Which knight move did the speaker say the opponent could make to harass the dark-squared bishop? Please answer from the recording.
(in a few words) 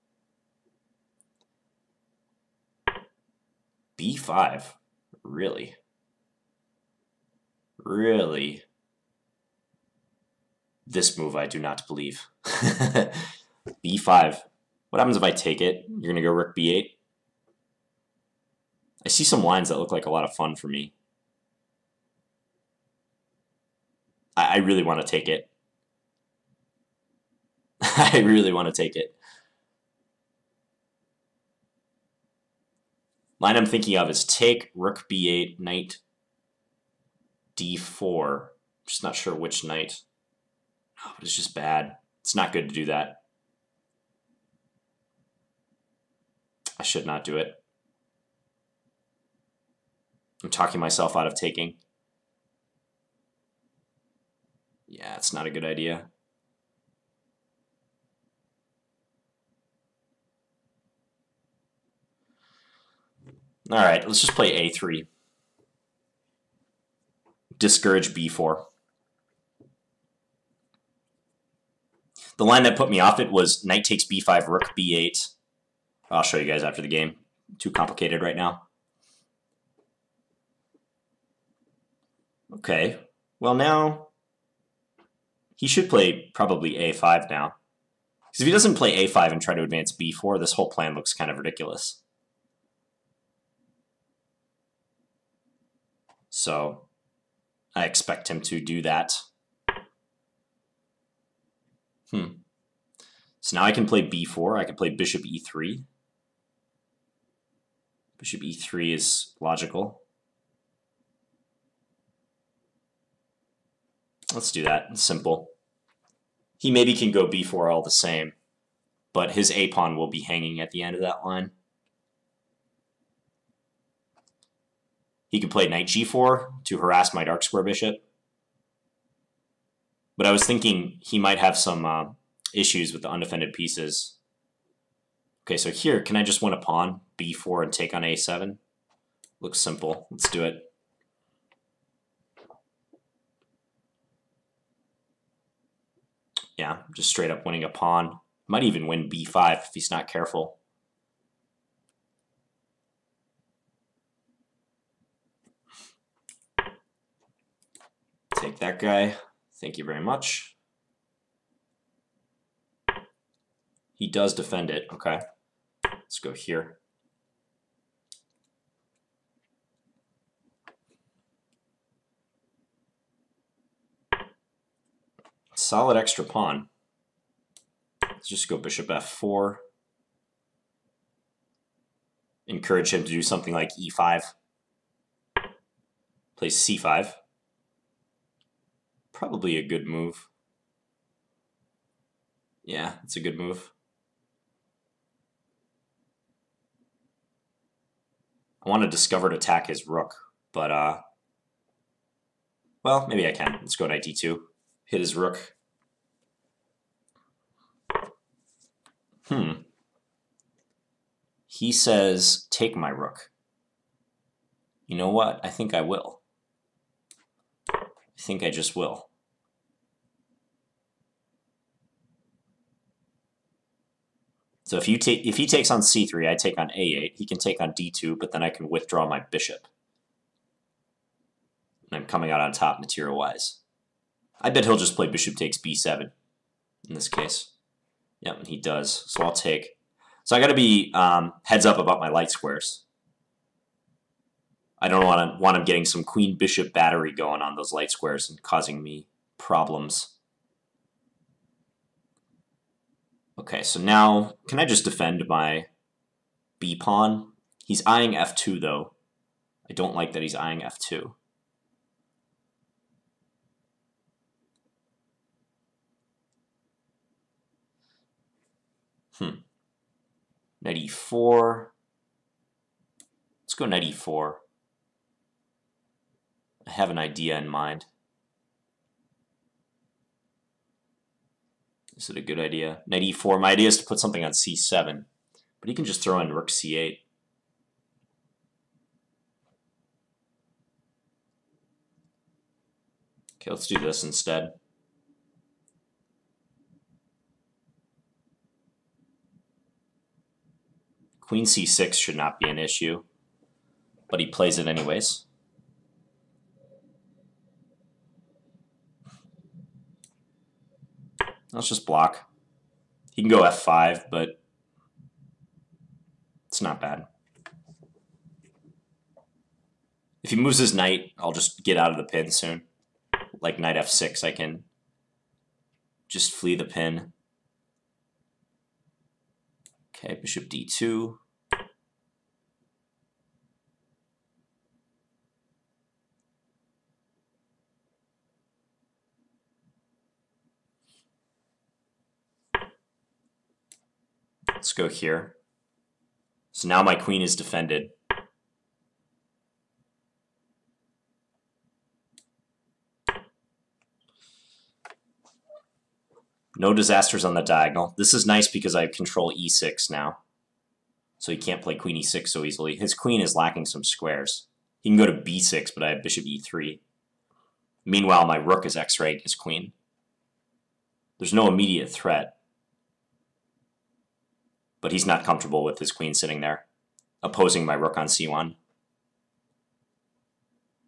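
knight g4.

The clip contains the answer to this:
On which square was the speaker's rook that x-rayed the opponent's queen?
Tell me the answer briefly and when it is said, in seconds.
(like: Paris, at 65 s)
c1, at 378 s.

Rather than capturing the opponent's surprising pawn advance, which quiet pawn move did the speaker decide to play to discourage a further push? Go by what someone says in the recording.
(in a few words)
a3.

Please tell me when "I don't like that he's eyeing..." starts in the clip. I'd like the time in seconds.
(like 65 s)
259 s.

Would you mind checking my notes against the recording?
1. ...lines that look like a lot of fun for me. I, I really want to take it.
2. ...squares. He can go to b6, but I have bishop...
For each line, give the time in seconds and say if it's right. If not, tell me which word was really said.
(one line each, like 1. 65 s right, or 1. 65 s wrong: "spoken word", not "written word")
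1. 19 s right
2. 363 s right.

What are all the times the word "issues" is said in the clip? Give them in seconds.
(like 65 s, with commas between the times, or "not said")
132 s, 302 s.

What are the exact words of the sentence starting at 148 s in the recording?
Might even win b5 if he's not careful.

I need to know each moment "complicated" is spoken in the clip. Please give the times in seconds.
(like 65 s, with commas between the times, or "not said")
77 s.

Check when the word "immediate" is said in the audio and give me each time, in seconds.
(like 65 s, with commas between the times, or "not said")
371 s.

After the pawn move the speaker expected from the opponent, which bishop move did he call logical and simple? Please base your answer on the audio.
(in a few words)
Bishop e3.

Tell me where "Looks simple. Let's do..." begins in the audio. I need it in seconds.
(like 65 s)
139 s.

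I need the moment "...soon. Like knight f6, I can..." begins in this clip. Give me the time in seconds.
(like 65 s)
322 s.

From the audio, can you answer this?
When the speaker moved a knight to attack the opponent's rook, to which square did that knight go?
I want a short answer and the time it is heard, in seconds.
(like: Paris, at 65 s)
d2, at 203 s.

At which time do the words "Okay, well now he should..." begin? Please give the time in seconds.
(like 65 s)
82 s.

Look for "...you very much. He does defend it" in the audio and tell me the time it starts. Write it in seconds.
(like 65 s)
159 s.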